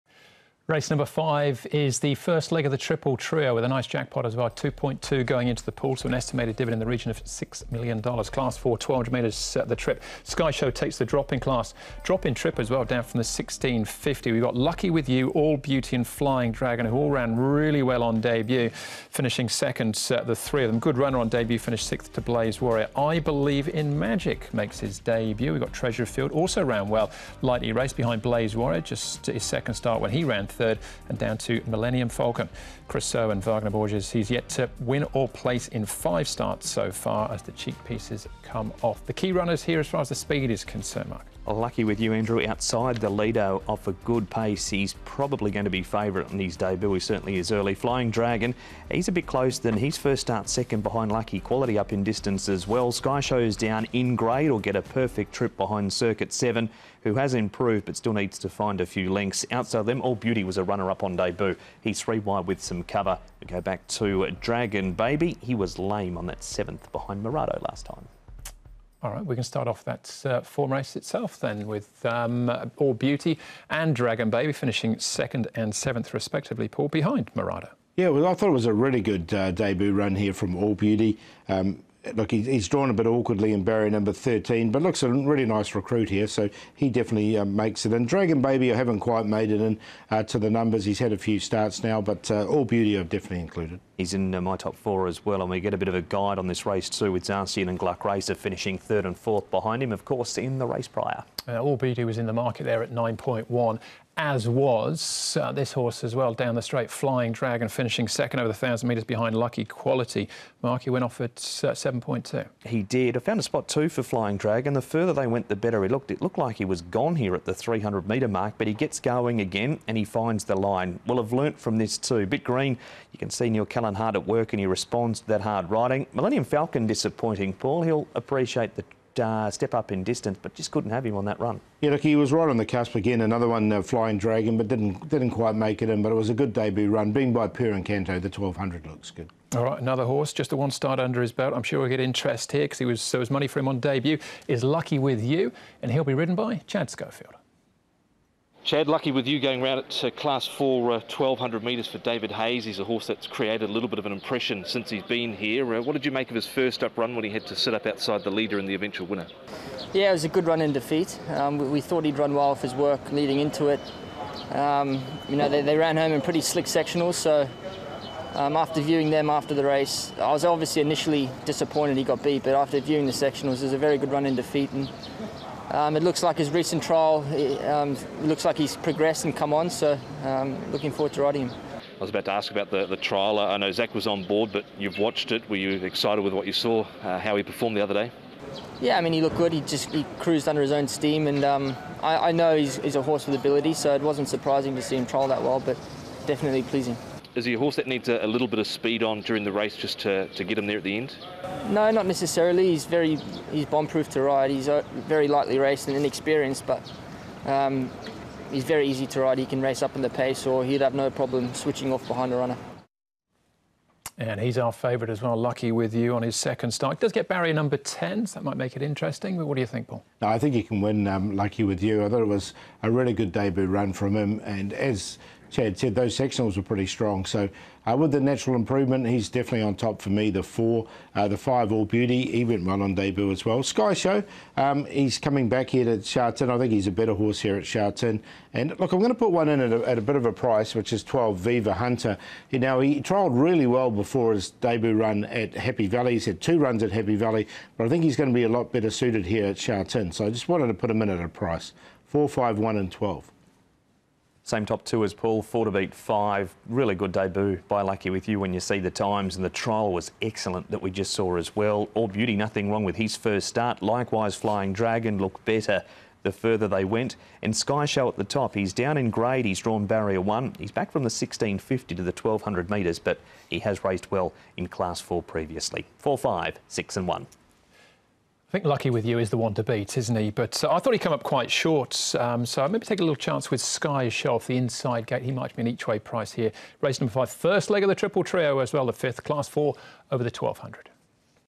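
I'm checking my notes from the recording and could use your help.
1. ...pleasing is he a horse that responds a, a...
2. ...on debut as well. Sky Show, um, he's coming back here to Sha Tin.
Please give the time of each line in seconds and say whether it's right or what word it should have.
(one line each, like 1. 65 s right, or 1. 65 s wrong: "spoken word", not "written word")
1. 196 s wrong: "needs", not "responds"
2. 232 s right.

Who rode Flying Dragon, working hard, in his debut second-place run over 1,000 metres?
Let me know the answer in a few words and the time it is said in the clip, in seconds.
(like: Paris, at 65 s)
Neil Callan, at 123 s.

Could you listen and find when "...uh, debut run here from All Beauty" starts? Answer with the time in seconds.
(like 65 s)
79 s.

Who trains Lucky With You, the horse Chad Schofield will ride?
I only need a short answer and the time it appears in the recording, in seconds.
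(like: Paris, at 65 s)
David Hayes, at 151 s.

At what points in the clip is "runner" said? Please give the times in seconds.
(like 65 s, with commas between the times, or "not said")
20 s, 39 s, 60 s, 212 s.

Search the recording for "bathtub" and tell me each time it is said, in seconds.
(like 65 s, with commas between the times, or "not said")
not said.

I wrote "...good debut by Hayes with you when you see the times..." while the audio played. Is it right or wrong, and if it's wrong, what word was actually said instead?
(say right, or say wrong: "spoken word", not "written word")
wrong: "Lucky", not "Hayes".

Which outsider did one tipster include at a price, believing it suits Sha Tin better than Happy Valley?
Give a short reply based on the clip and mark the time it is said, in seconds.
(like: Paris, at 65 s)
Viva Hunter, at 241 s.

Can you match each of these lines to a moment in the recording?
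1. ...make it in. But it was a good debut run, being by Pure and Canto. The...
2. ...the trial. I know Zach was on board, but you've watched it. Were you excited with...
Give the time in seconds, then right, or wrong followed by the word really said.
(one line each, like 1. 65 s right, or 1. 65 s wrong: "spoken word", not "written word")
1. 135 s right
2. 182 s right.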